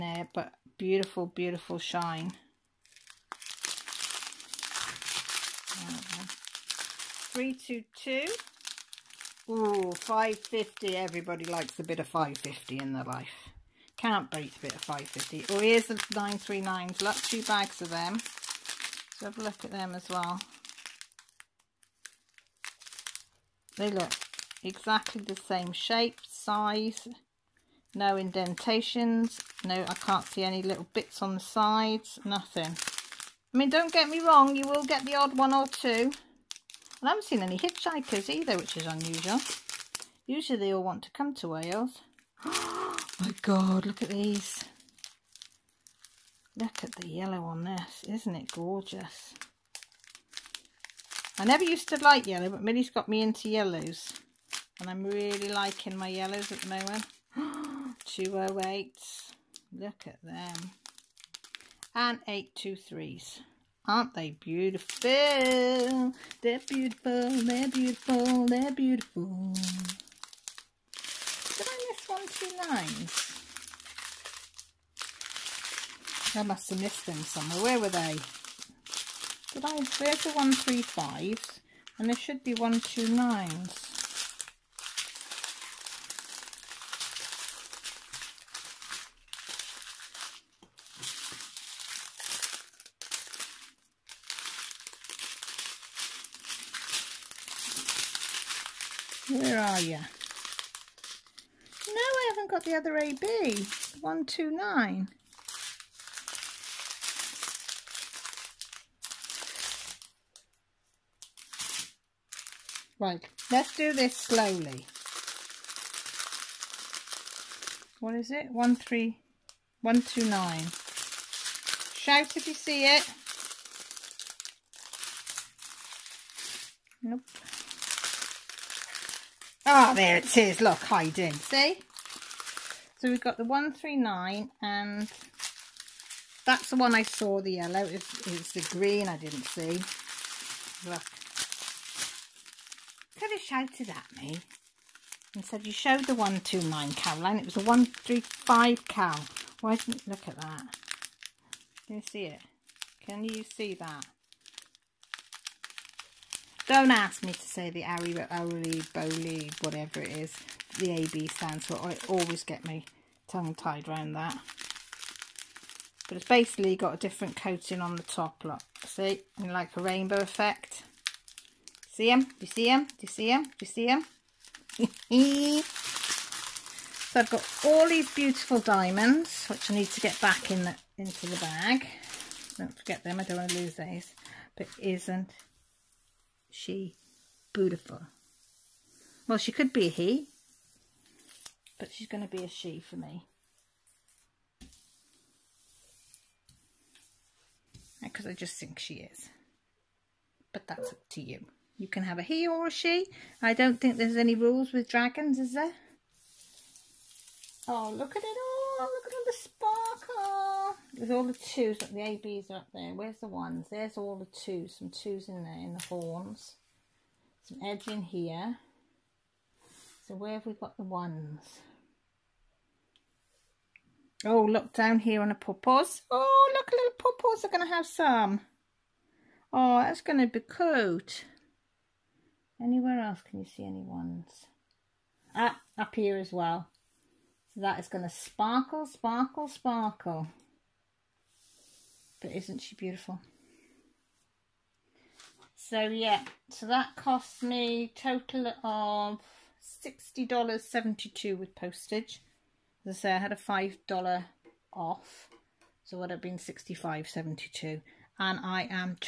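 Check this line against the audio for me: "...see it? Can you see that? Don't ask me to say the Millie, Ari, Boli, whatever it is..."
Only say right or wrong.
wrong.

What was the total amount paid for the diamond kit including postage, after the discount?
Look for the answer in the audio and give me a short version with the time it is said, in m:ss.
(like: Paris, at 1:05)
$60.72, at 4:09.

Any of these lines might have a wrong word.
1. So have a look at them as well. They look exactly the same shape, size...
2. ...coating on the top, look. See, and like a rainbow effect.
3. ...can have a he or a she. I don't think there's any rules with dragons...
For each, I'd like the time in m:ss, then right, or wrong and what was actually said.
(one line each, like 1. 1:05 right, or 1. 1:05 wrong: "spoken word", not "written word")
1. 0:19 right
2. 2:47 right
3. 3:21 right.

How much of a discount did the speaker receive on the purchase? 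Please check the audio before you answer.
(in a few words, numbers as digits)
$5.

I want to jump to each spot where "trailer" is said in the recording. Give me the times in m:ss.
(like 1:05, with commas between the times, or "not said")
not said.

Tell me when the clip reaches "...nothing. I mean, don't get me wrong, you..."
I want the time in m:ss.
0:32.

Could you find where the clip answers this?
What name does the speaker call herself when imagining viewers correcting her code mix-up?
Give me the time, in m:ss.
2:26.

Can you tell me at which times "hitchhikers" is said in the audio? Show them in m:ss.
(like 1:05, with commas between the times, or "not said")
0:37.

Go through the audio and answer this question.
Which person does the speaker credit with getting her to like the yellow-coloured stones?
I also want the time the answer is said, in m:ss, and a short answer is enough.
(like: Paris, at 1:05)
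Millie, at 0:52.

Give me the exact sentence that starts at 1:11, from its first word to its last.
Did I miss one, two I must have missed them somewhere.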